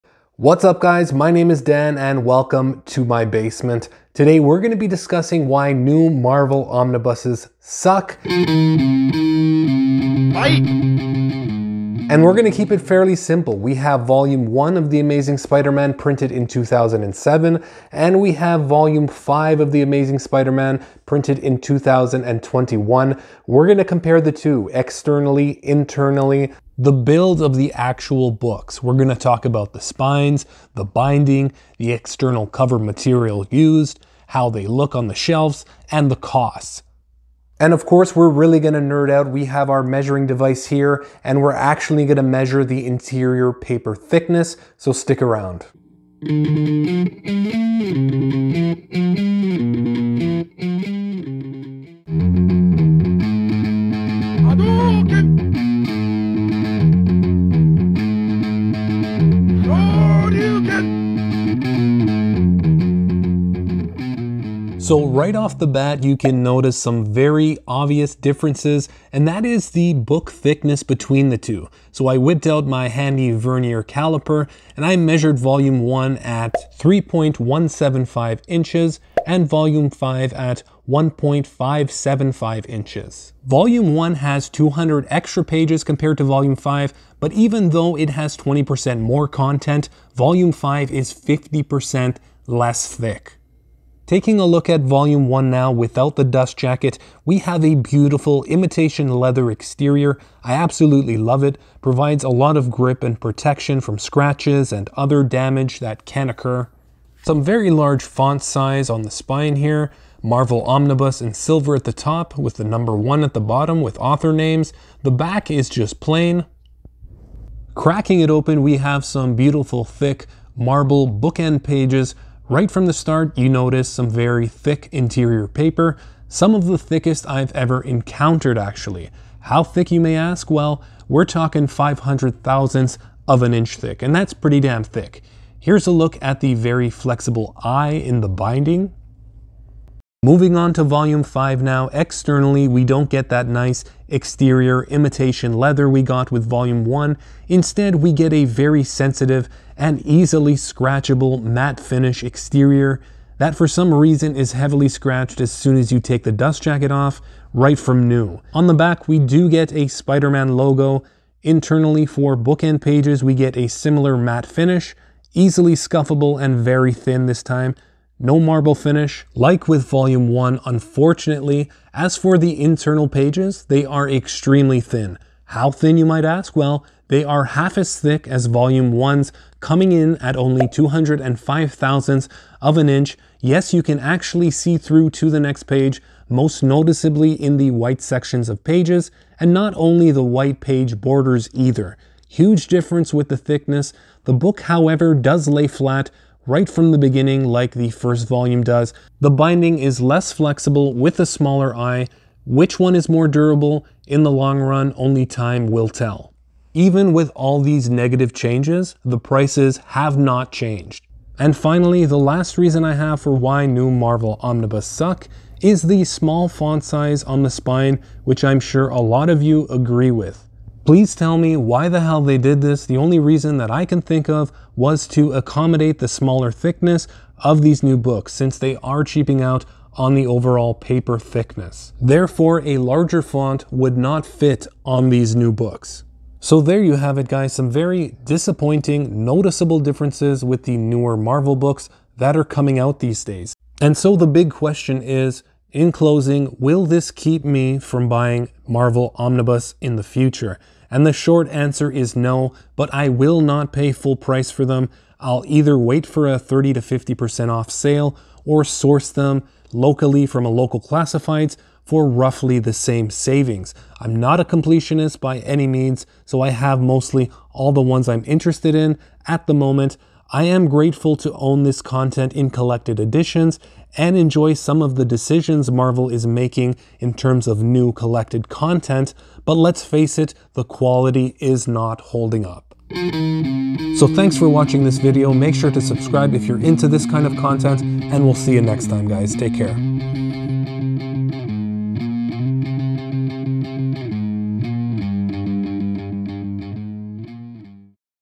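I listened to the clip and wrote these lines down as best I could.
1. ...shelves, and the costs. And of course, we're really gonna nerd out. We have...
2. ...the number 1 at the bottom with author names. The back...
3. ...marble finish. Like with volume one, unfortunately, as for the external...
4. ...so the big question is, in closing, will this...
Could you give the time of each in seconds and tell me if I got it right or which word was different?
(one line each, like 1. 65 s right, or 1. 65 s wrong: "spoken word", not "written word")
1. 35 s right
2. 112 s right
3. 168 s wrong: "internal", not "external"
4. 243 s right.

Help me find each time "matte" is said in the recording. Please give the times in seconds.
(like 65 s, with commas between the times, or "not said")
151 s, 164 s.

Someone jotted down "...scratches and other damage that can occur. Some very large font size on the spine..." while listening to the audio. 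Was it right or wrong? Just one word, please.
right.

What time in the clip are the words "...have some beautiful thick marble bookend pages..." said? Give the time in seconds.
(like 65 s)
118 s.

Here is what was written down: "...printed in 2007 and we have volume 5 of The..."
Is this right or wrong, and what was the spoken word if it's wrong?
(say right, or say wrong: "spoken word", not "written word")
right.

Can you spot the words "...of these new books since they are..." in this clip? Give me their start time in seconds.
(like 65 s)
227 s.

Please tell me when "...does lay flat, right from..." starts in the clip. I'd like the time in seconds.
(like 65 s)
195 s.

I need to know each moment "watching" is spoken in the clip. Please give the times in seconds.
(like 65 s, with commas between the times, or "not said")
284 s.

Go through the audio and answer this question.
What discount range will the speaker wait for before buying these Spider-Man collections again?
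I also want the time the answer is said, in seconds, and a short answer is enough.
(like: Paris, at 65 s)
30 to 50%, at 256 s.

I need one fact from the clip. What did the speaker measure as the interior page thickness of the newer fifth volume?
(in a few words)
205 thousandths of an inch.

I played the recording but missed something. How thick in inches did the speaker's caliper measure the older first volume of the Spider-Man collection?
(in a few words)
3.175 inches.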